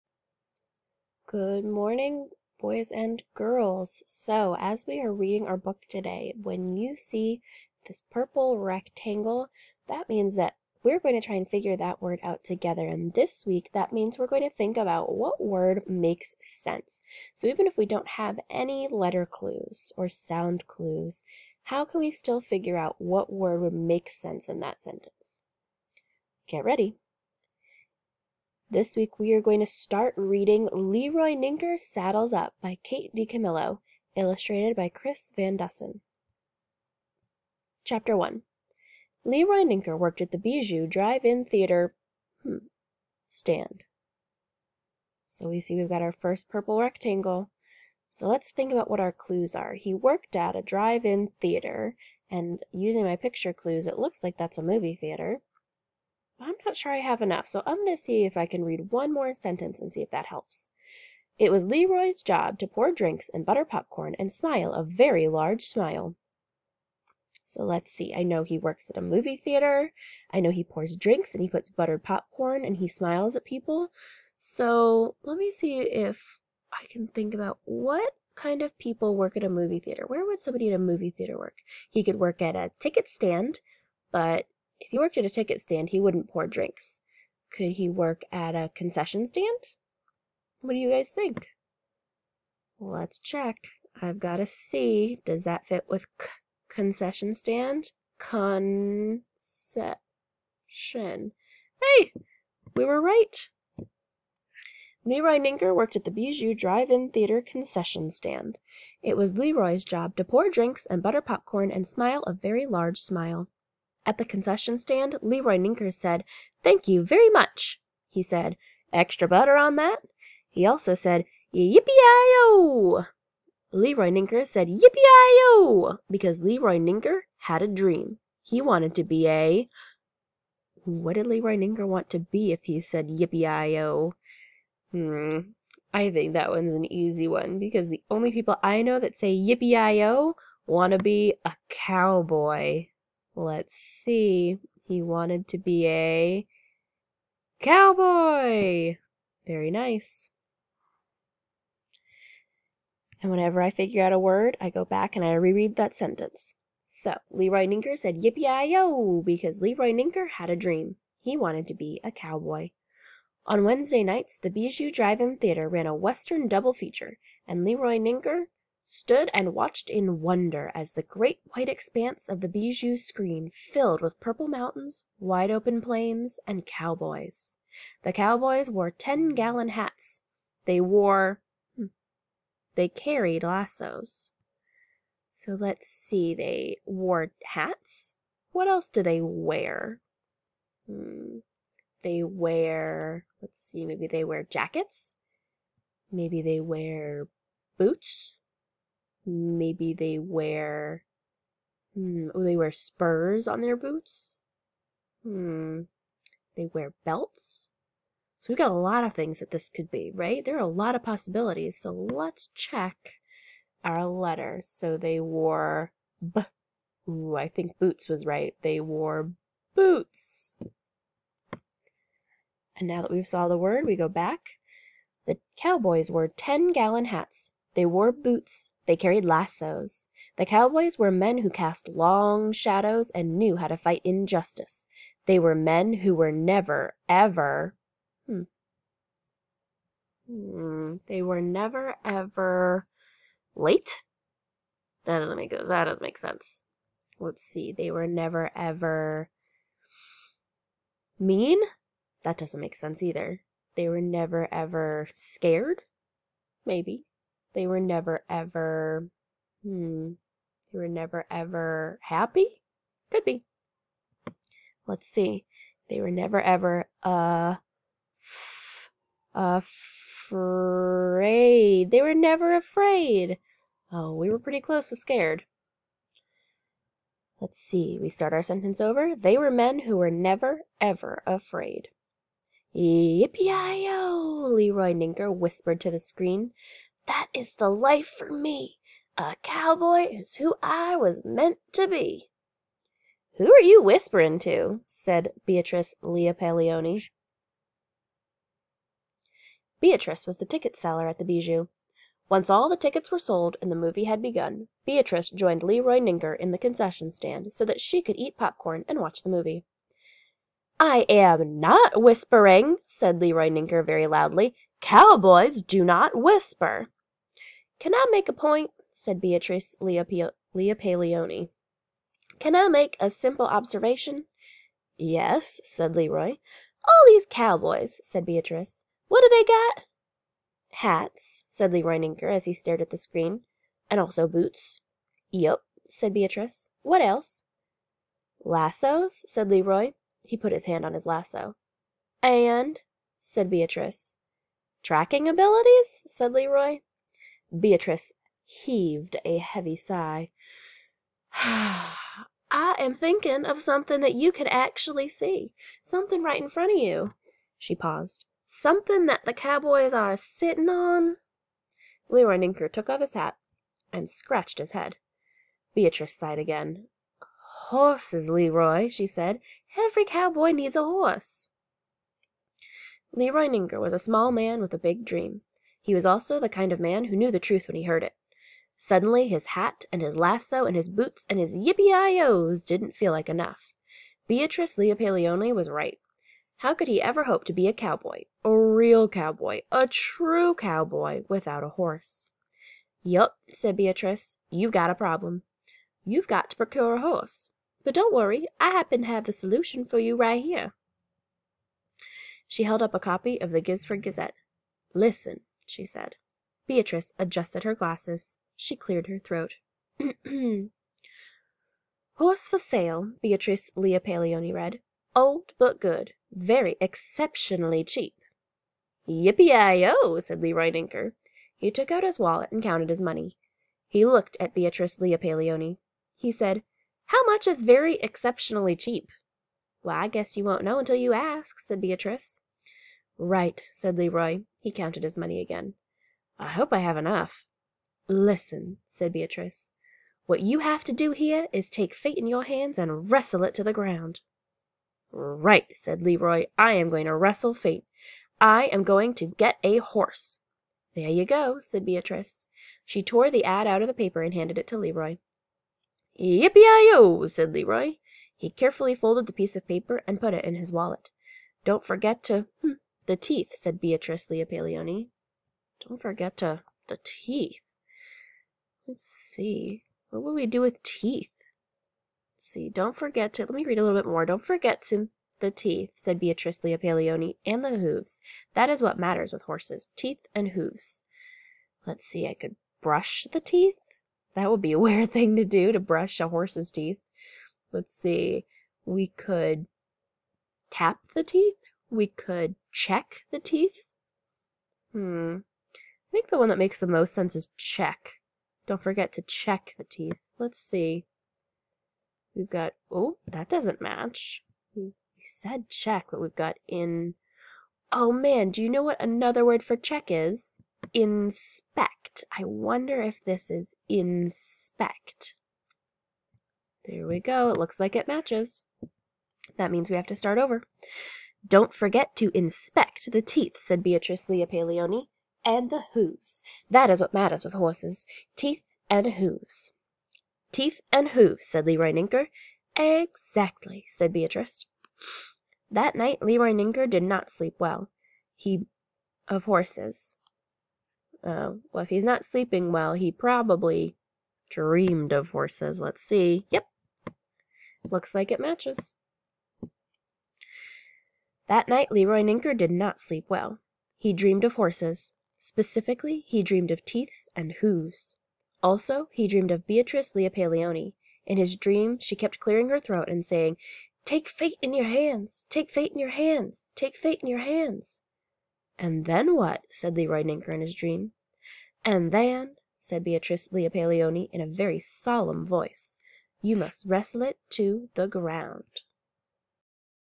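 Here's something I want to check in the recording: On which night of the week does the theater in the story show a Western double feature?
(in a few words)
Wednesday.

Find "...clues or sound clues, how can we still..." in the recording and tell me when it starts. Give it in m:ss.
0:19.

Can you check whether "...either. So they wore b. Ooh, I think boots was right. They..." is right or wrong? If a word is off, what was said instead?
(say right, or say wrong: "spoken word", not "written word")
wrong: "letter", not "either".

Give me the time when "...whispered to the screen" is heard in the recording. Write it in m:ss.
4:45.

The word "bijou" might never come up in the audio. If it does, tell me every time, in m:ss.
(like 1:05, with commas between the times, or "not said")
0:40, 1:46, 2:44, 2:52, 5:01.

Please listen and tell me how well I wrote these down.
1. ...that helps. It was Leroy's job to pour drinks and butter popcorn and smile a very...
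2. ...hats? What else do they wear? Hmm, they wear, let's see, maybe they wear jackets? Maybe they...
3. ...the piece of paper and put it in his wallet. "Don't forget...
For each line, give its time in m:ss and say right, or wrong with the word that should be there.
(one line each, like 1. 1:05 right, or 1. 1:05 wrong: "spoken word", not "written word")
1. 1:00 right
2. 3:07 right
3. 7:39 right.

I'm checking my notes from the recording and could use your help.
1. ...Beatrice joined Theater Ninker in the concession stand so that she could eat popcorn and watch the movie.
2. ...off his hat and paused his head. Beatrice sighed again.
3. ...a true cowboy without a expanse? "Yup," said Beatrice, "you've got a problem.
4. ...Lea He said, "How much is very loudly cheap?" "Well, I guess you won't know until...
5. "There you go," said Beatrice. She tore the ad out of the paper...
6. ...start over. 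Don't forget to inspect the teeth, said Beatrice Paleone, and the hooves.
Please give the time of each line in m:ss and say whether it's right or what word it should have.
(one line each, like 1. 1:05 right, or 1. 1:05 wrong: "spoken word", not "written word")
1. 5:04 wrong: "Leroy", not "Theater"
2. 6:02 wrong: "scratched", not "paused"
3. 6:29 wrong: "horse", not "expanse"
4. 7:04 wrong: "exceptionally", not "loudly"
5. 7:30 right
6. 8:40 right.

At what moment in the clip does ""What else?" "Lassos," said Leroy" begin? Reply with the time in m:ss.
5:36.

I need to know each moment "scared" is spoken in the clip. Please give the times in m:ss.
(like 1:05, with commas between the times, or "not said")
4:15, 4:34.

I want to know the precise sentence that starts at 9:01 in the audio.
Oh, well, if he's not sleeping well, he probably dreamed of horses.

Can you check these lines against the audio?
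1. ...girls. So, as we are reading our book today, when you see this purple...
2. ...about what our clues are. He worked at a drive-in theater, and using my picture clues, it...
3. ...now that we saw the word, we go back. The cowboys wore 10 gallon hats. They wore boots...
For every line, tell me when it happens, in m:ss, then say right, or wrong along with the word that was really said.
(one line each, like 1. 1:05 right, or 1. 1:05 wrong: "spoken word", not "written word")
1. 0:03 right
2. 0:48 right
3. 3:42 right.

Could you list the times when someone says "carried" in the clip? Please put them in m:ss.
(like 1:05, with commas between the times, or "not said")
3:02, 3:48.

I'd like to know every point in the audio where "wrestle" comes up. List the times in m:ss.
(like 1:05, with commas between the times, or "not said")
7:23, 7:27, 9:36.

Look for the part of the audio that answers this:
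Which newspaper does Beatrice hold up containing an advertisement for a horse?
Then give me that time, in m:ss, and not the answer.
6:43.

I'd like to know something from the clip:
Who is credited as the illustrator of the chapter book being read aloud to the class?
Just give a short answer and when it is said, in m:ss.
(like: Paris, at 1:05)
Chris Van Dusen, at 0:34.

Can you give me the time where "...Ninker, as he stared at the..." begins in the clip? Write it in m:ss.
5:31.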